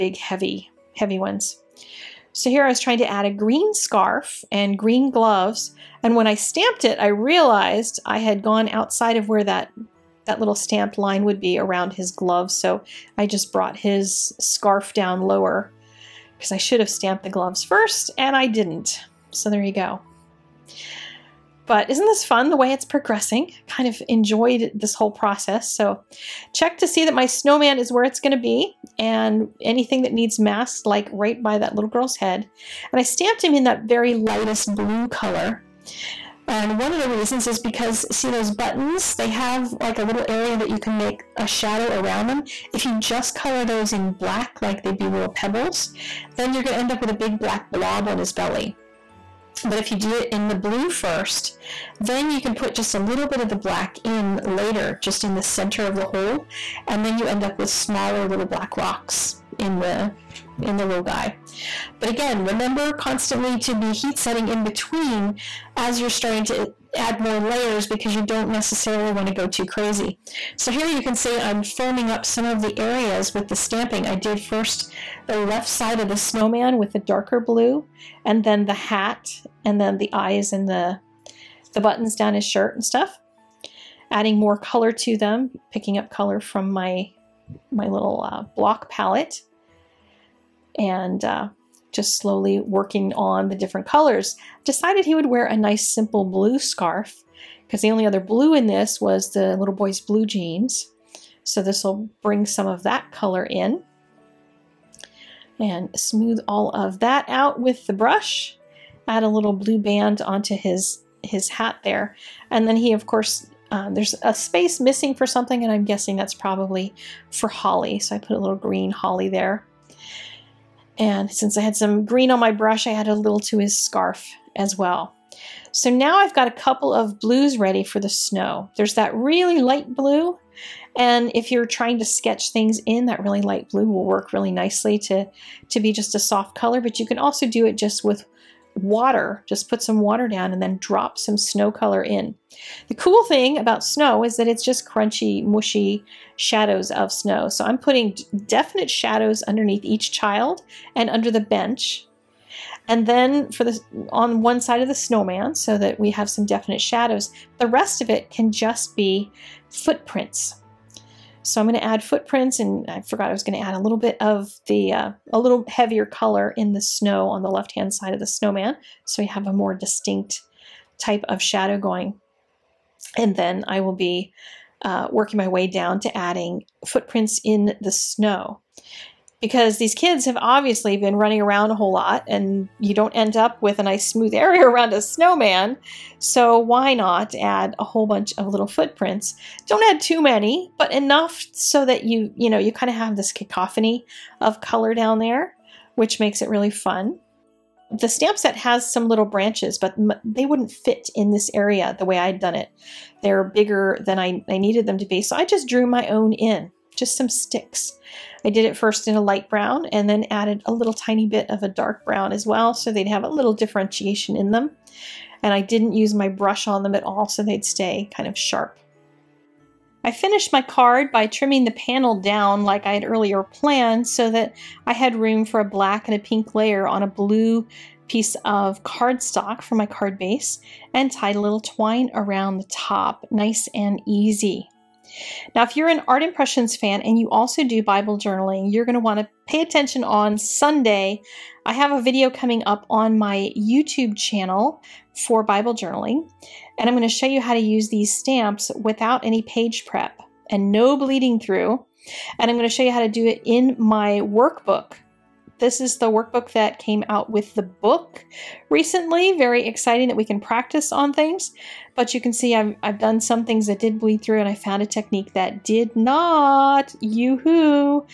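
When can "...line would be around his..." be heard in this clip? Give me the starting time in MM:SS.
00:10.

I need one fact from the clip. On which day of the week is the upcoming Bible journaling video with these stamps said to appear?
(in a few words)
Sunday.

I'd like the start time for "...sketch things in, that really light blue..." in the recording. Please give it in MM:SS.
02:12.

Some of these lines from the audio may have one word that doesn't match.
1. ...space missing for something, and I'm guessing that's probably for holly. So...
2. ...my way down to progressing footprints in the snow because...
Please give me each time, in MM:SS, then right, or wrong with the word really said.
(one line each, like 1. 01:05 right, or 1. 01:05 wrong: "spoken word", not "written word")
1. 01:54 right
2. 02:55 wrong: "adding", not "progressing".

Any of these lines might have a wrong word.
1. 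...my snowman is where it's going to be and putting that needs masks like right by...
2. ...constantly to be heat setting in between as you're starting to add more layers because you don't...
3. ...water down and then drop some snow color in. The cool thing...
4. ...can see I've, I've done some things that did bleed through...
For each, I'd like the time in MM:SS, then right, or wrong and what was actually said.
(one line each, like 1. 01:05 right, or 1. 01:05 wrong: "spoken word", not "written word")
1. 00:27 wrong: "anything", not "putting"
2. 01:02 right
3. 02:19 right
4. 04:22 right.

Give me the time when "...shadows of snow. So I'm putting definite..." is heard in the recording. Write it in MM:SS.
02:26.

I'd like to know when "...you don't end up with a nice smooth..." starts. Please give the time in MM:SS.
03:02.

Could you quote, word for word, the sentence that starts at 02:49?
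So we have a more distinct type of shadow going.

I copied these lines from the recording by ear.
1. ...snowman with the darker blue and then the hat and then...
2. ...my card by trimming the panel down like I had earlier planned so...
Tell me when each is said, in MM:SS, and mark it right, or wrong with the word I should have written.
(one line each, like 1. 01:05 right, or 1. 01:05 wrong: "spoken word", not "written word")
1. 01:16 right
2. 03:40 right.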